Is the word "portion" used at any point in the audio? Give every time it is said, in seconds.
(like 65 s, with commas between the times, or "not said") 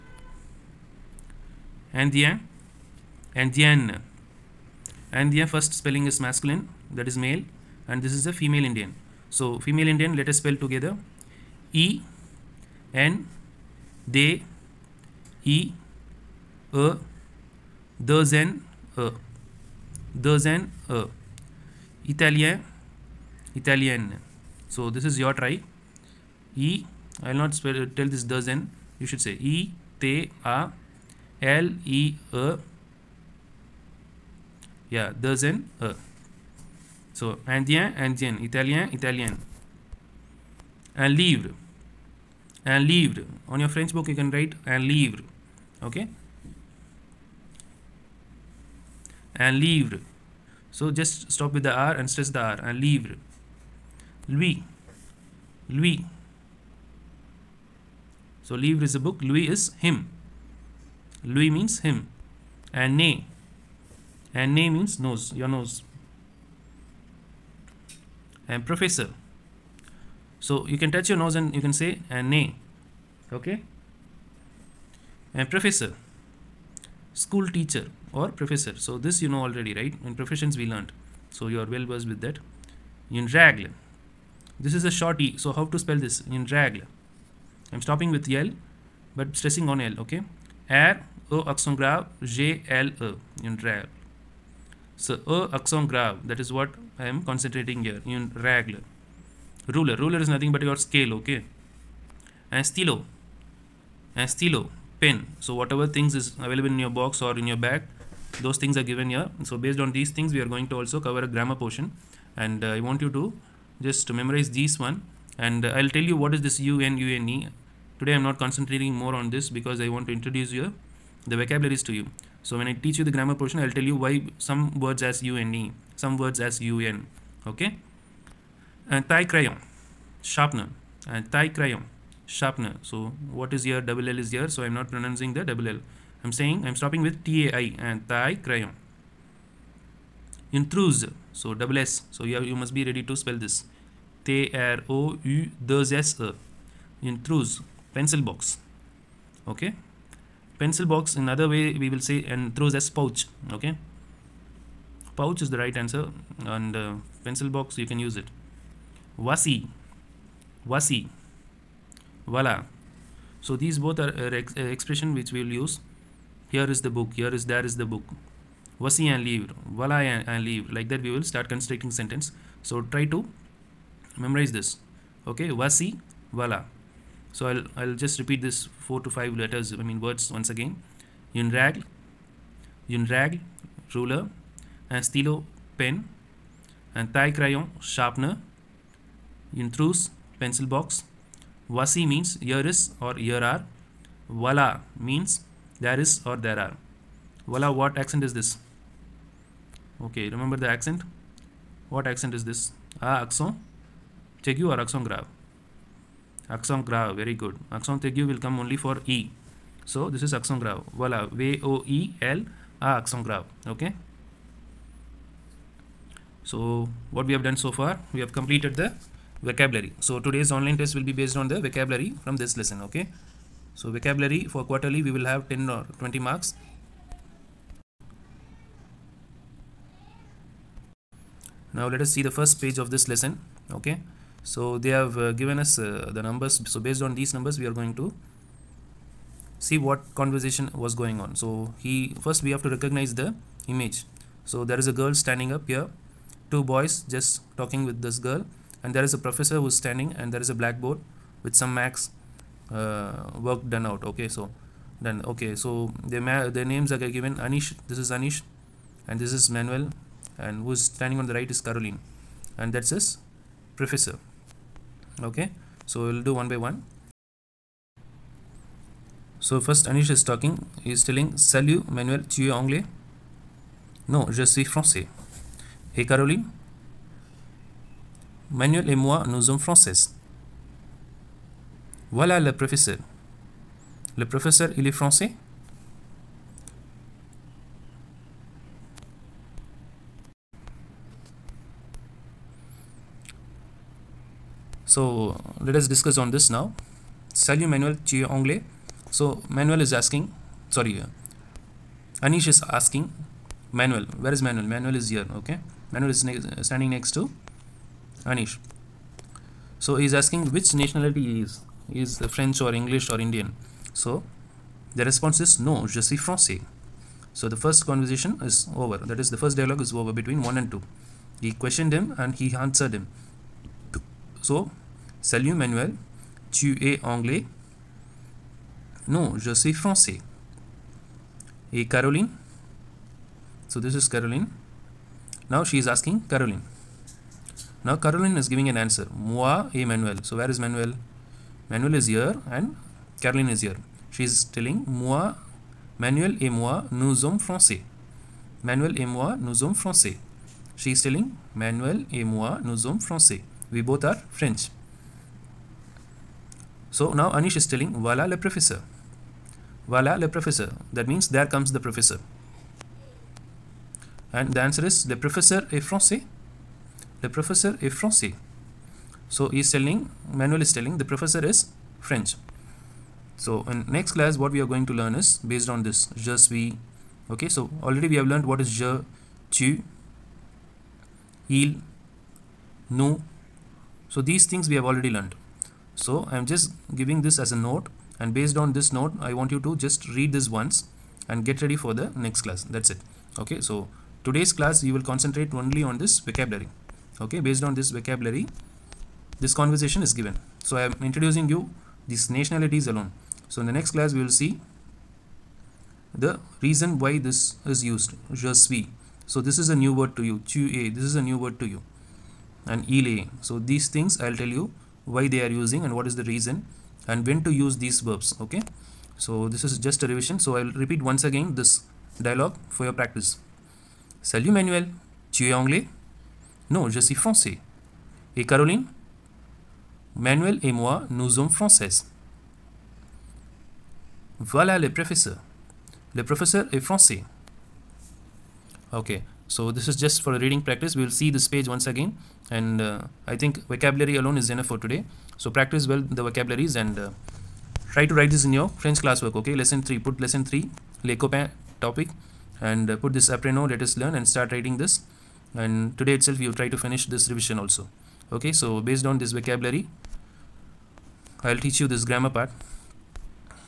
111 s, 123 s.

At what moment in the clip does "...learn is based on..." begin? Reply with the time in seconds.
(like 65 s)
374 s.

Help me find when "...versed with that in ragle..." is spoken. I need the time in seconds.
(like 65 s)
81 s.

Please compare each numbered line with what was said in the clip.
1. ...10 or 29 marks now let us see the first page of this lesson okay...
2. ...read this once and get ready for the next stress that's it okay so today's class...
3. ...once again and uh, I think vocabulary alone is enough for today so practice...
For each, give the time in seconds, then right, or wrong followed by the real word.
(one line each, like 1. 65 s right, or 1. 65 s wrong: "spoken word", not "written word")
1. 225 s wrong: "20", not "29"
2. 390 s wrong: "class", not "stress"
3. 441 s right.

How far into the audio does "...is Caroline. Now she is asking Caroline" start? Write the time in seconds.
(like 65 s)
333 s.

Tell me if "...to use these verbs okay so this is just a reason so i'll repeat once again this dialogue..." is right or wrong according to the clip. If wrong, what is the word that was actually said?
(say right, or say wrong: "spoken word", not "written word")
wrong: "revision", not "reason".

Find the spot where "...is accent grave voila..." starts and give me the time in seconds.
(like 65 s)
210 s.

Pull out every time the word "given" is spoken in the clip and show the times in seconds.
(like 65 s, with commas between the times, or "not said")
108 s, 235 s, 257 s, 400 s.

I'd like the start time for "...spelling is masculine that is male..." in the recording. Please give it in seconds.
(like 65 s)
5 s.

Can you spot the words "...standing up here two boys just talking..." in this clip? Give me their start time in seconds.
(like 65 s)
245 s.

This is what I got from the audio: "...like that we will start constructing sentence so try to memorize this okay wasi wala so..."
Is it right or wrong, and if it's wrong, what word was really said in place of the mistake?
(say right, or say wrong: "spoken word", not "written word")
right.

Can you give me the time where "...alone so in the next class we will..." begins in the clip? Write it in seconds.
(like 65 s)
402 s.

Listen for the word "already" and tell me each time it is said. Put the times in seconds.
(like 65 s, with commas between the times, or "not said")
79 s, 377 s, 384 s.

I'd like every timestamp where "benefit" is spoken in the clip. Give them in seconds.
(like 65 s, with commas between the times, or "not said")
not said.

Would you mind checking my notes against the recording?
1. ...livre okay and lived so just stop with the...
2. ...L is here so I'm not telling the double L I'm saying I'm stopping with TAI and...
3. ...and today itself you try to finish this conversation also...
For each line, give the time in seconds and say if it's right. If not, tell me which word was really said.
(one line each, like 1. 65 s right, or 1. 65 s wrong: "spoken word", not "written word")
1. 44 s right
2. 134 s wrong: "pronouncing", not "telling"
3. 455 s wrong: "revision", not "conversation".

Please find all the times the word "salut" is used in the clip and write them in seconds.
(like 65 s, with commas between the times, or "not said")
271 s, 297 s, 325 s, 424 s.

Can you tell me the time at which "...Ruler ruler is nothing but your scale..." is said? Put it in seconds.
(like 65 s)
99 s.